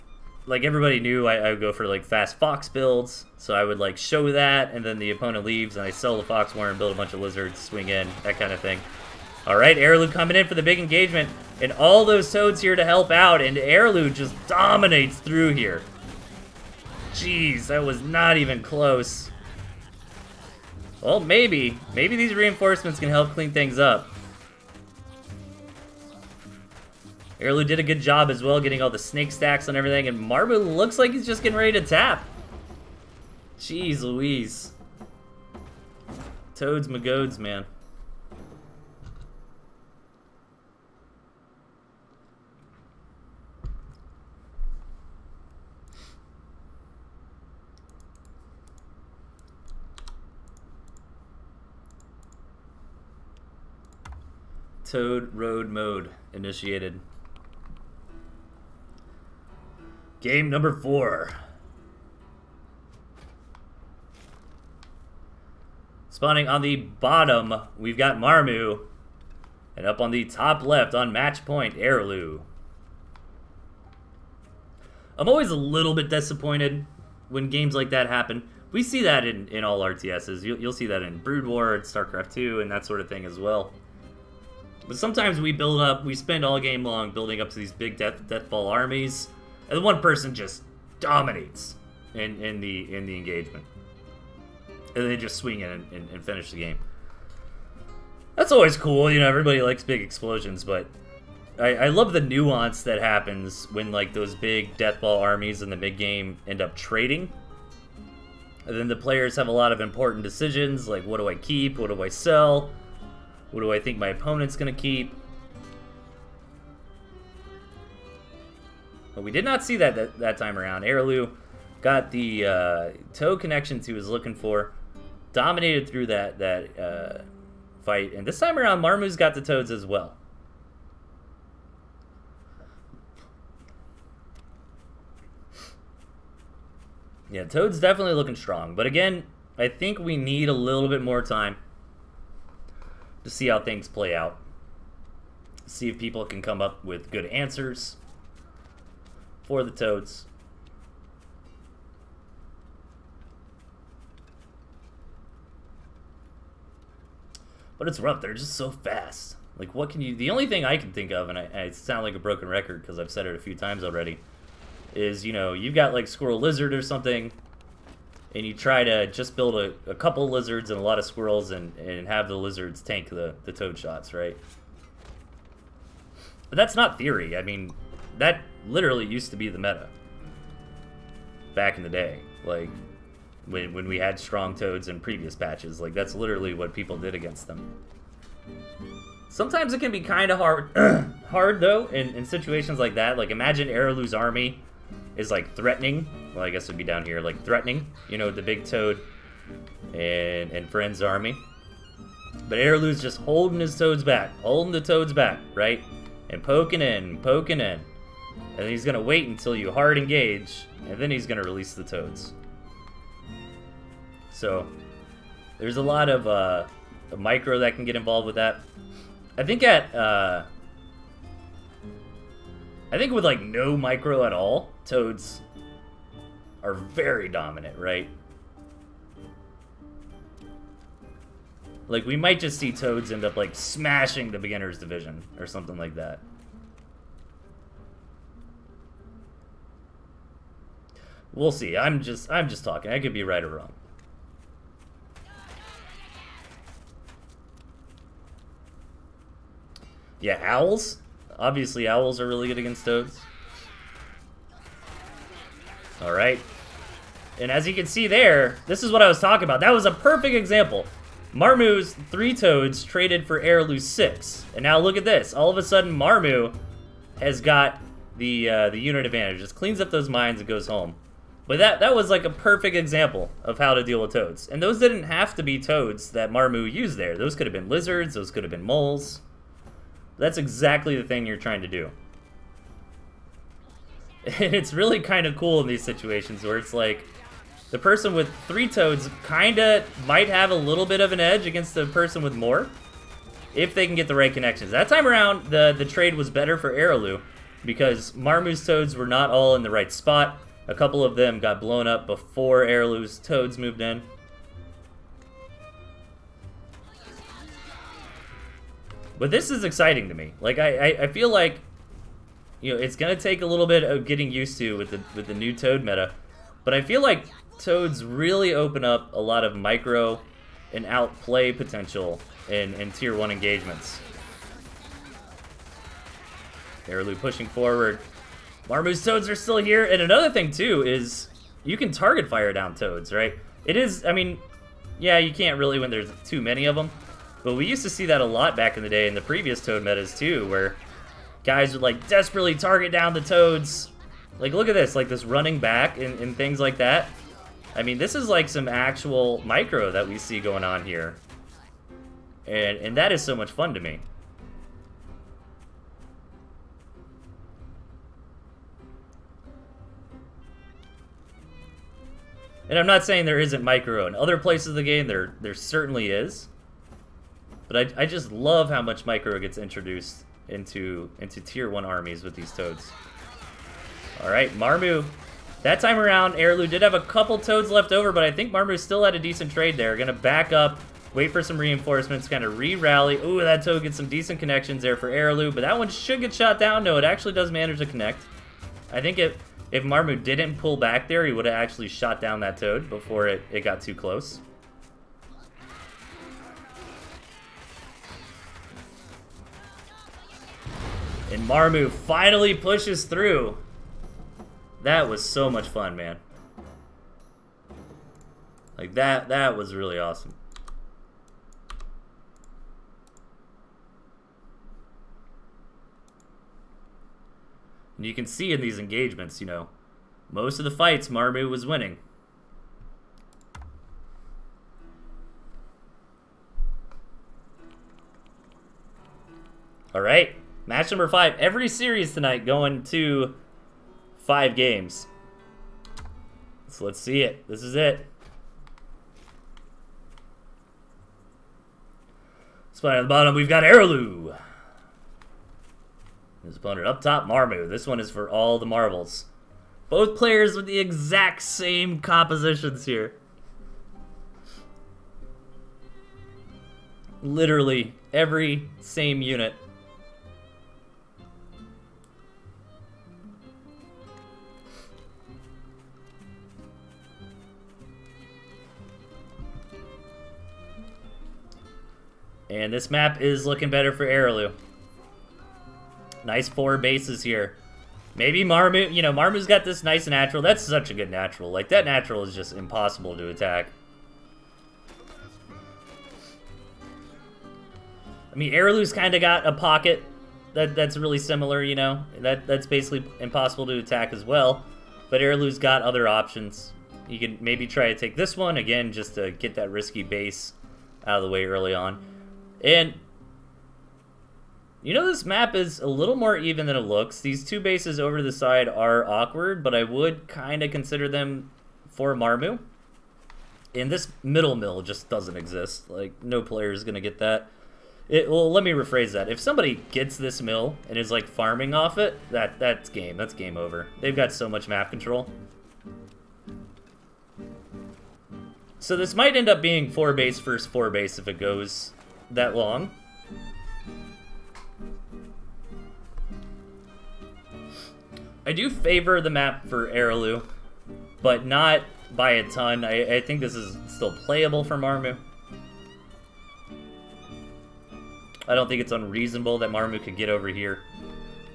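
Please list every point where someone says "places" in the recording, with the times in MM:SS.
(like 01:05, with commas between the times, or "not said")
06:04.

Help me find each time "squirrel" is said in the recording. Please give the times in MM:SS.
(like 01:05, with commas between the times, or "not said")
02:46, 02:51.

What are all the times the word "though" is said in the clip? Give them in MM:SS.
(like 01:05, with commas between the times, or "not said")
03:11.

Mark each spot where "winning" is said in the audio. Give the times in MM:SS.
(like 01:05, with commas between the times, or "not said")
07:01.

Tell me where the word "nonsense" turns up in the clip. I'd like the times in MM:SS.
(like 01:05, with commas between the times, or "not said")
not said.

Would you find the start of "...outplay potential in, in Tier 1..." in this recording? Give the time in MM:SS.
05:20.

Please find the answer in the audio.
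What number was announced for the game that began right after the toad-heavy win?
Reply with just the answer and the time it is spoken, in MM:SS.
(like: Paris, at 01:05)
4, at 01:00.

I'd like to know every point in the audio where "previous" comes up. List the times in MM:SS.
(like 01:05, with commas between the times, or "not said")
03:04, 05:39.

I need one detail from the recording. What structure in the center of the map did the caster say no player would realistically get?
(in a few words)
middle mill.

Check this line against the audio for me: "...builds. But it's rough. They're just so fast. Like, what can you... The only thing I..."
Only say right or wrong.
wrong.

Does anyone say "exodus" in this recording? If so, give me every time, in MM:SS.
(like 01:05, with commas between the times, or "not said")
not said.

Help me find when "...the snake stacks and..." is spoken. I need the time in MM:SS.
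00:28.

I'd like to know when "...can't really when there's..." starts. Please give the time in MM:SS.
05:35.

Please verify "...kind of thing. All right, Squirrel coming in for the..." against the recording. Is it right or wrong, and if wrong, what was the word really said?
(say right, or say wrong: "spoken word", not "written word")
wrong: "Arilou", not "Squirrel".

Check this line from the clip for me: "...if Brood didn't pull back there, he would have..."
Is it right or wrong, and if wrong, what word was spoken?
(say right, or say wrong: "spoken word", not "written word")
wrong: "Marmu", not "Brood".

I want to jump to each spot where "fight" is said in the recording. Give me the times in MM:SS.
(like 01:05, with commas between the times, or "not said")
02:07, 07:00.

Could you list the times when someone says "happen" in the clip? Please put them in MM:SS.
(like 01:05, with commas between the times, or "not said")
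01:18, 01:42.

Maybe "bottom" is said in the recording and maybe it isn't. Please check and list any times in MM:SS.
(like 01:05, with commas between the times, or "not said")
01:06, 07:23.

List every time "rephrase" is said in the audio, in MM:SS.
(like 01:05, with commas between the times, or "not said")
08:38.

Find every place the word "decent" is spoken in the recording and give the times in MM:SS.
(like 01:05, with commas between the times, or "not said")
06:19, 06:24.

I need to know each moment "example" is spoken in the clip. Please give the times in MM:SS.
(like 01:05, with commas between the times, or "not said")
04:20, 04:32.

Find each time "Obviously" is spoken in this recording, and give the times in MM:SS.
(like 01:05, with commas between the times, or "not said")
04:11.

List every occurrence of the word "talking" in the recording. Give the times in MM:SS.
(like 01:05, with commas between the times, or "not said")
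04:02, 04:19.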